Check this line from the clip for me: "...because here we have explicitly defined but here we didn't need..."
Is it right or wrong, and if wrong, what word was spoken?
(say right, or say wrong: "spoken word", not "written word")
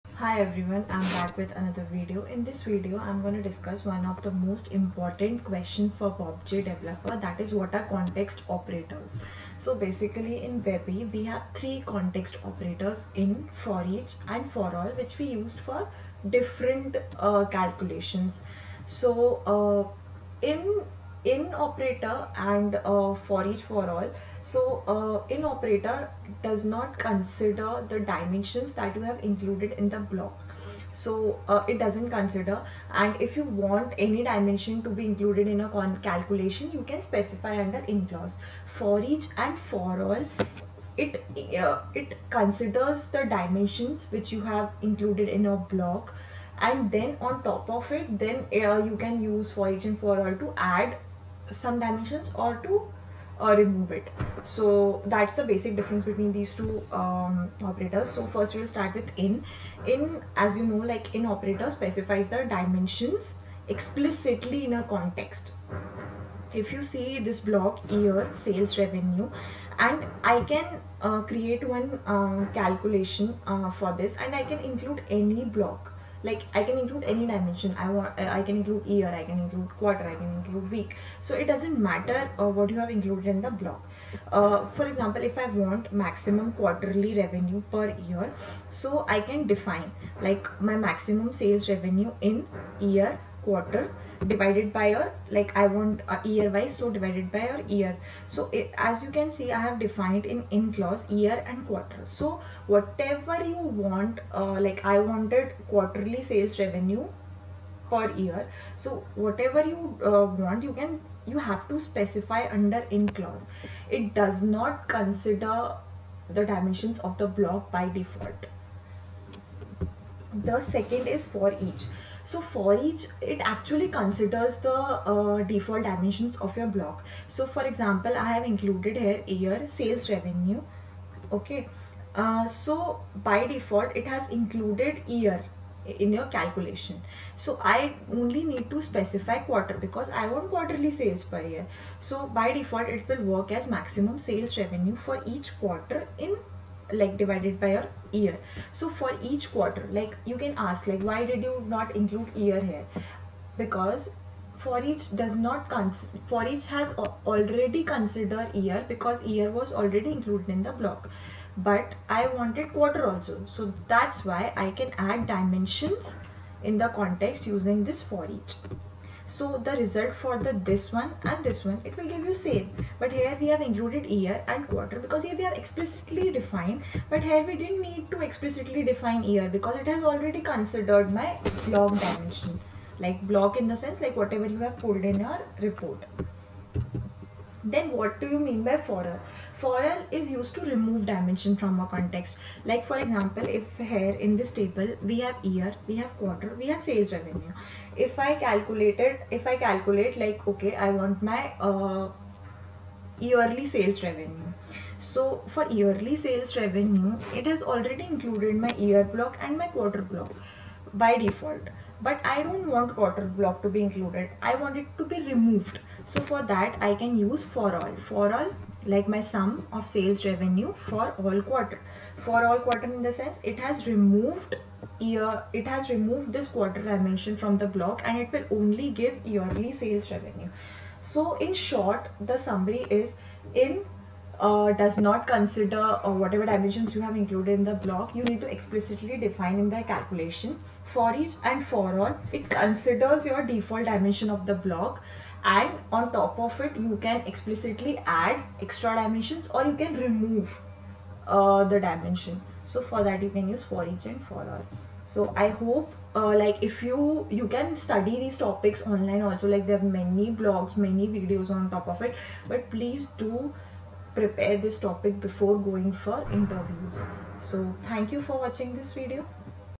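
right.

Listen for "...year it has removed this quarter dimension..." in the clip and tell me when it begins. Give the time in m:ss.
3:44.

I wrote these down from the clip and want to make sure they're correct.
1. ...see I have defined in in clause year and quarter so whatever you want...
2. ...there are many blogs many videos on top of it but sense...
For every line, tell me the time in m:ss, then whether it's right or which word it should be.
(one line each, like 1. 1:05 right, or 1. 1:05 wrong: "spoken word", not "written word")
1. 1:39 right
2. 4:19 wrong: "please", not "sense".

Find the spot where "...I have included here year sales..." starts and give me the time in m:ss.
2:08.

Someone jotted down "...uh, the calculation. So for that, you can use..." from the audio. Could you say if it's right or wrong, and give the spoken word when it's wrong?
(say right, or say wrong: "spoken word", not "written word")
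wrong: "dimension", not "calculation".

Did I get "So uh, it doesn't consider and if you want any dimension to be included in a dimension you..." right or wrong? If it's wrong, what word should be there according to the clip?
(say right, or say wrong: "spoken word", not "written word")
wrong: "calculation", not "dimension".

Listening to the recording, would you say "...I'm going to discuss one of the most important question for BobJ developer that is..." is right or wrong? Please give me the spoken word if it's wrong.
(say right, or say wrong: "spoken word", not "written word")
right.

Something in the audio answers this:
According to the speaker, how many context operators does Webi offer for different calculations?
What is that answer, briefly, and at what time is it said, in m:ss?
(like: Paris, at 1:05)
3, at 0:11.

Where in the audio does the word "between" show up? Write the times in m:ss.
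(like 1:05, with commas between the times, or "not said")
0:56.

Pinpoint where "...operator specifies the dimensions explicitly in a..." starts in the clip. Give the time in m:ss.
1:01.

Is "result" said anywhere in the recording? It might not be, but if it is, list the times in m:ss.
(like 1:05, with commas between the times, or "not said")
2:49.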